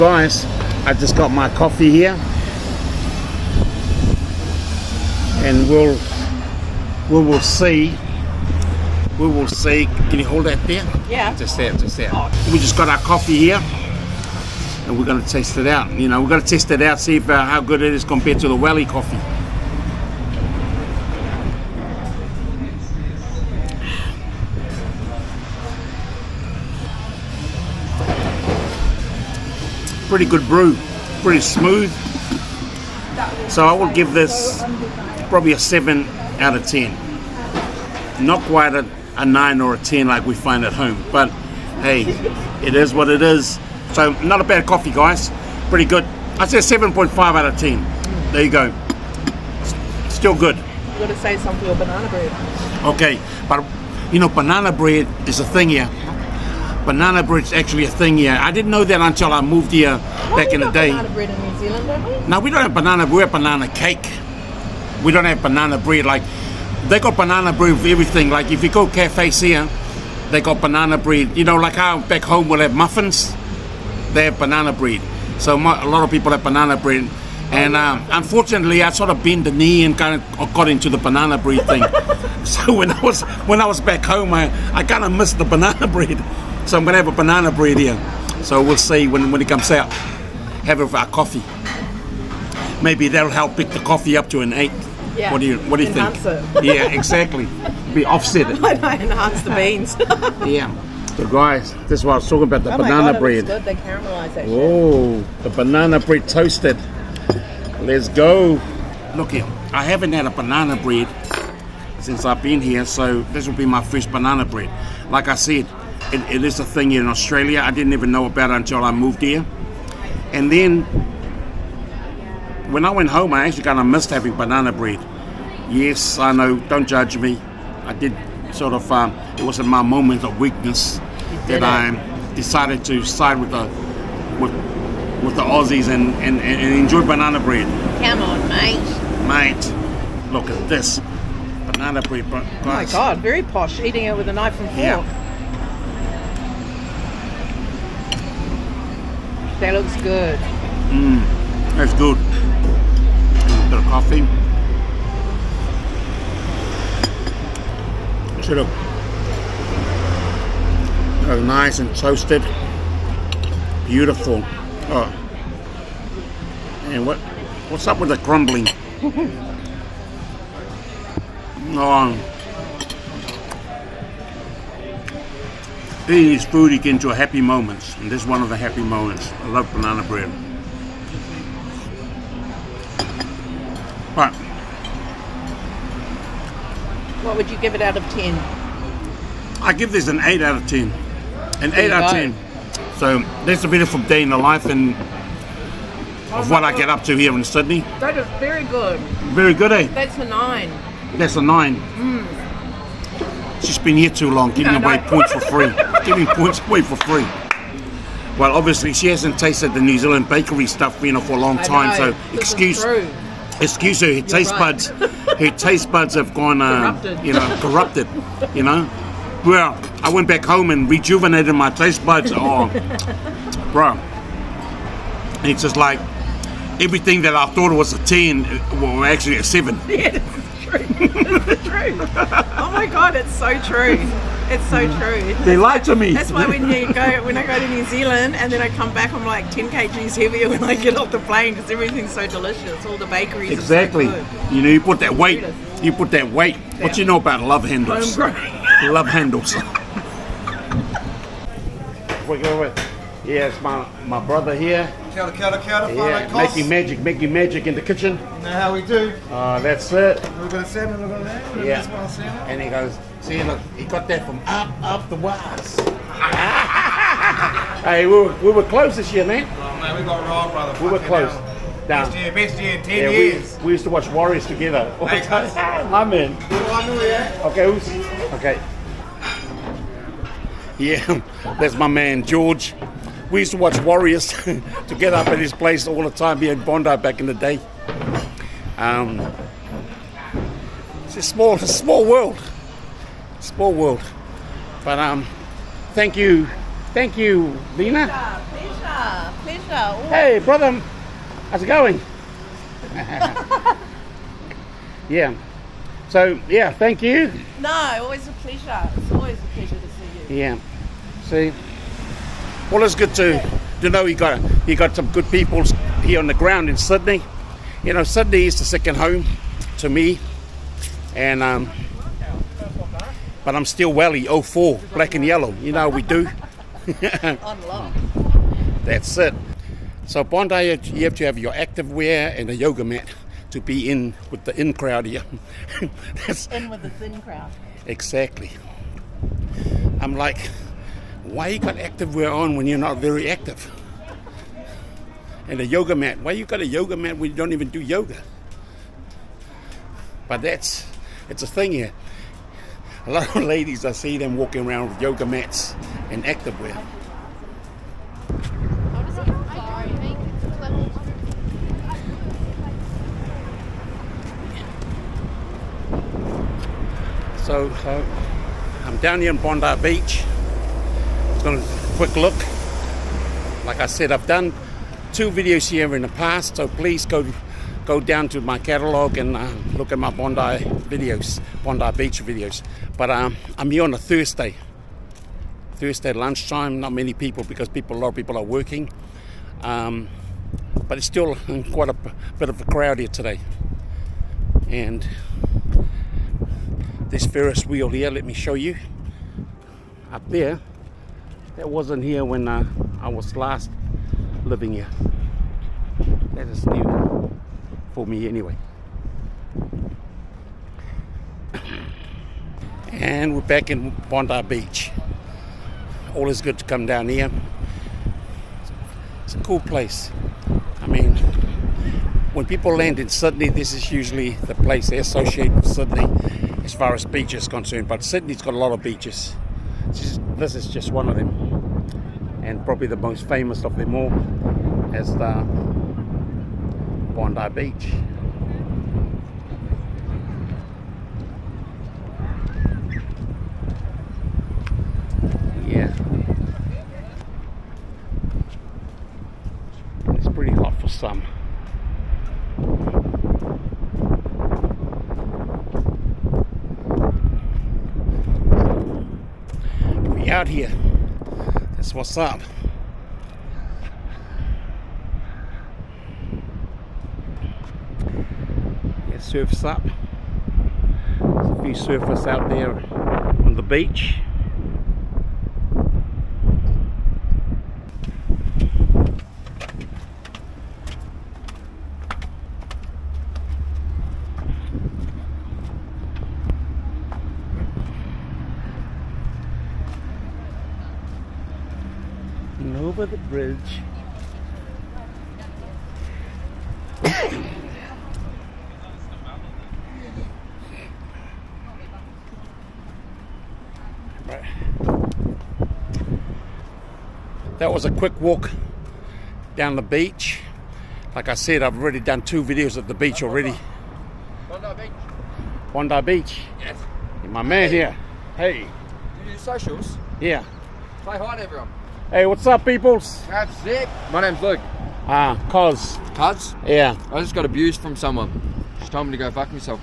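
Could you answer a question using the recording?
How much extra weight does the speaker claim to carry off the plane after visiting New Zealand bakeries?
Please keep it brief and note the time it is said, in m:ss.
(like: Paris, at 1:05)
10 kgs, at 3:59.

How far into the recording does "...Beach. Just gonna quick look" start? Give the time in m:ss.
6:09.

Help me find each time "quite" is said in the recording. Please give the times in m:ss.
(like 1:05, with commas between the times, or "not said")
0:38, 6:31.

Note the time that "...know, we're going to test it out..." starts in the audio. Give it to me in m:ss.
0:16.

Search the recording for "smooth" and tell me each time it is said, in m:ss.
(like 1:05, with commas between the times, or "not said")
0:31.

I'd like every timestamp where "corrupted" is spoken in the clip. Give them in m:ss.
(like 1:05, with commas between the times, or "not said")
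3:37.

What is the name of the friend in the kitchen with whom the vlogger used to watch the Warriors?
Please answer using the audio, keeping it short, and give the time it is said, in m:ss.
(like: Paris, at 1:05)
George, at 4:42.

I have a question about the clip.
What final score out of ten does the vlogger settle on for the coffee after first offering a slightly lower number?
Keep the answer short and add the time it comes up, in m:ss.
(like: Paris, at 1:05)
7.5, at 0:46.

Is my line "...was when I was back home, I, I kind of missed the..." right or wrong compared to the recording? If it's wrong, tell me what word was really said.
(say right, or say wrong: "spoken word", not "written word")
right.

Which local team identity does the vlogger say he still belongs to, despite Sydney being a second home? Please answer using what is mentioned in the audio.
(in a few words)
Welly 04.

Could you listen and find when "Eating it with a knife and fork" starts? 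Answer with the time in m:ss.
2:23.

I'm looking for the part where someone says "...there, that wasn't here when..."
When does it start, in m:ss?
6:40.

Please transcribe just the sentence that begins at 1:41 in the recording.
So guys, this is what I was talking about, the oh banana God, bread.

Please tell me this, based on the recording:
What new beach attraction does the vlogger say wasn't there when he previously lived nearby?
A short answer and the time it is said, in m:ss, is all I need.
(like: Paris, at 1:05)
Ferris wheel, at 6:37.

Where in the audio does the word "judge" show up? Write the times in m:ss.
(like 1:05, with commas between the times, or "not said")
2:06.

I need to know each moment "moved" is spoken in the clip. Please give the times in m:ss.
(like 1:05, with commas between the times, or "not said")
0:59, 1:58.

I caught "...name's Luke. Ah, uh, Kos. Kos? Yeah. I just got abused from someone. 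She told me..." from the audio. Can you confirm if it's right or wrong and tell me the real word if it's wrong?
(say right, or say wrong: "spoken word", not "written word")
right.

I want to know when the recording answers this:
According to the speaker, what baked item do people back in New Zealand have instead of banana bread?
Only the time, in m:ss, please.
1:03.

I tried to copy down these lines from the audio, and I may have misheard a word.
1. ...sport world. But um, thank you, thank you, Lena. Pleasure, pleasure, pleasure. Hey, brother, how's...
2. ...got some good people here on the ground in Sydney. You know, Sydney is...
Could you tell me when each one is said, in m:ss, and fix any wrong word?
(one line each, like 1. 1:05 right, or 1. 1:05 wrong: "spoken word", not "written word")
1. 4:53 right
2. 5:14 right.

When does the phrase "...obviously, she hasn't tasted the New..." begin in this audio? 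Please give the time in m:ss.
3:28.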